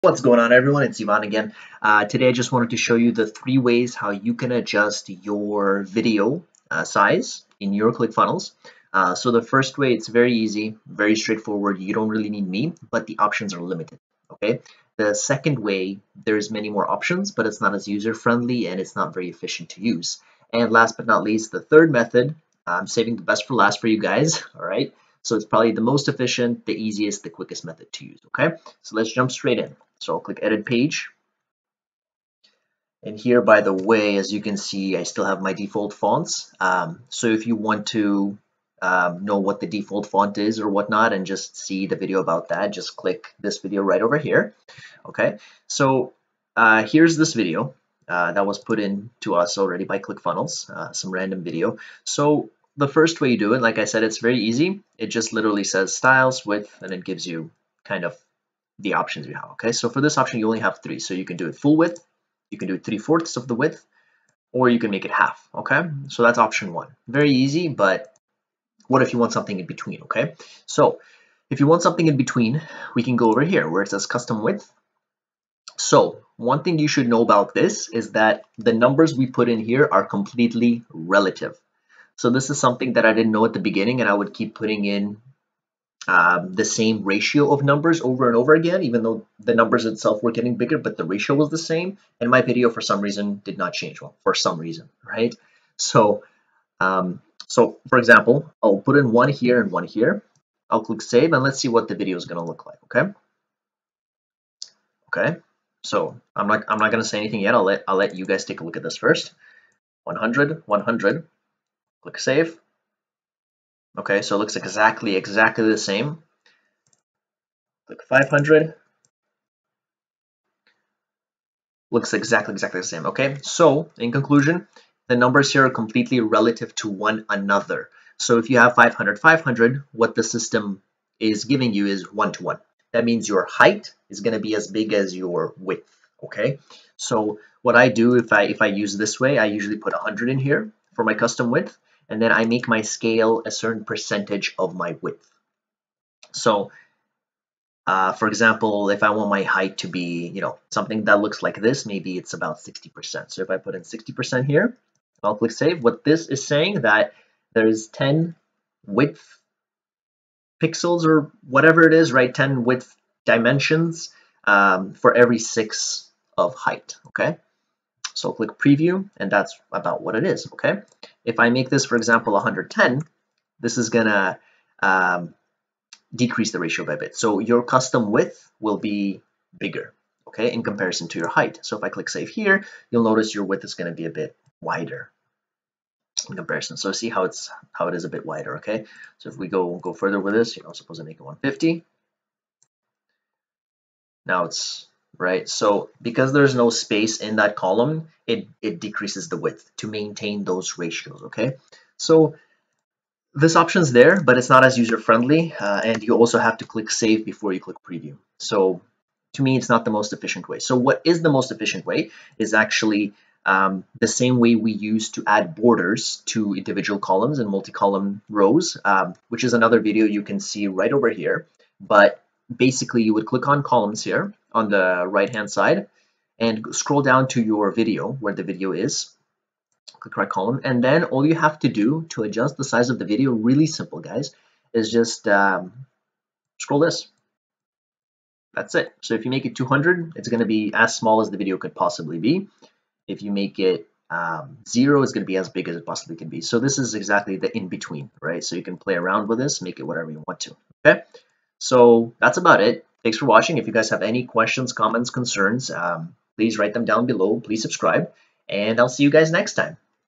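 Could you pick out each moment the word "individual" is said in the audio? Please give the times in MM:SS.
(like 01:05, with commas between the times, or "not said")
03:36.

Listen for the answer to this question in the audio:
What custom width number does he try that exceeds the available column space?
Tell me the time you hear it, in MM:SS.
03:11.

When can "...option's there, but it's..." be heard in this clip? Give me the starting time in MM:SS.
03:23.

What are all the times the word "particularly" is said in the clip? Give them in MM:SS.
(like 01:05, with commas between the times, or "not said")
not said.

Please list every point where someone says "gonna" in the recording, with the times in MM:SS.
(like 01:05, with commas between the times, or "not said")
02:53, 03:03.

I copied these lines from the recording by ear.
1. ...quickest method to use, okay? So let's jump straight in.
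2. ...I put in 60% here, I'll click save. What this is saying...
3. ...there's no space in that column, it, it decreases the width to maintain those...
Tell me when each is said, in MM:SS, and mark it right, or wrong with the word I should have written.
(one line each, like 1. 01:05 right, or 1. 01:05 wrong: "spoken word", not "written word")
1. 00:27 right
2. 02:33 right
3. 03:16 right.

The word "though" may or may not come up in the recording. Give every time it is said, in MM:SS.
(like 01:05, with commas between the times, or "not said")
01:29.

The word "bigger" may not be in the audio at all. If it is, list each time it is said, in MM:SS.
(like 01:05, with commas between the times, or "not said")
01:30, 02:59.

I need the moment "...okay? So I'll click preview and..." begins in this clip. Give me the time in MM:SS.
02:47.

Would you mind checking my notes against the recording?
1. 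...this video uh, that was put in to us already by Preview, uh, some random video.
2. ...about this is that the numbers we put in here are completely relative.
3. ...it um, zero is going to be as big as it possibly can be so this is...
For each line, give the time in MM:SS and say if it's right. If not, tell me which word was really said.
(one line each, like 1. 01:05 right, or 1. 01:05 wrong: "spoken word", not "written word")
1. 00:47 wrong: "ClickFunnels", not "Preview"
2. 01:17 right
3. 04:03 right.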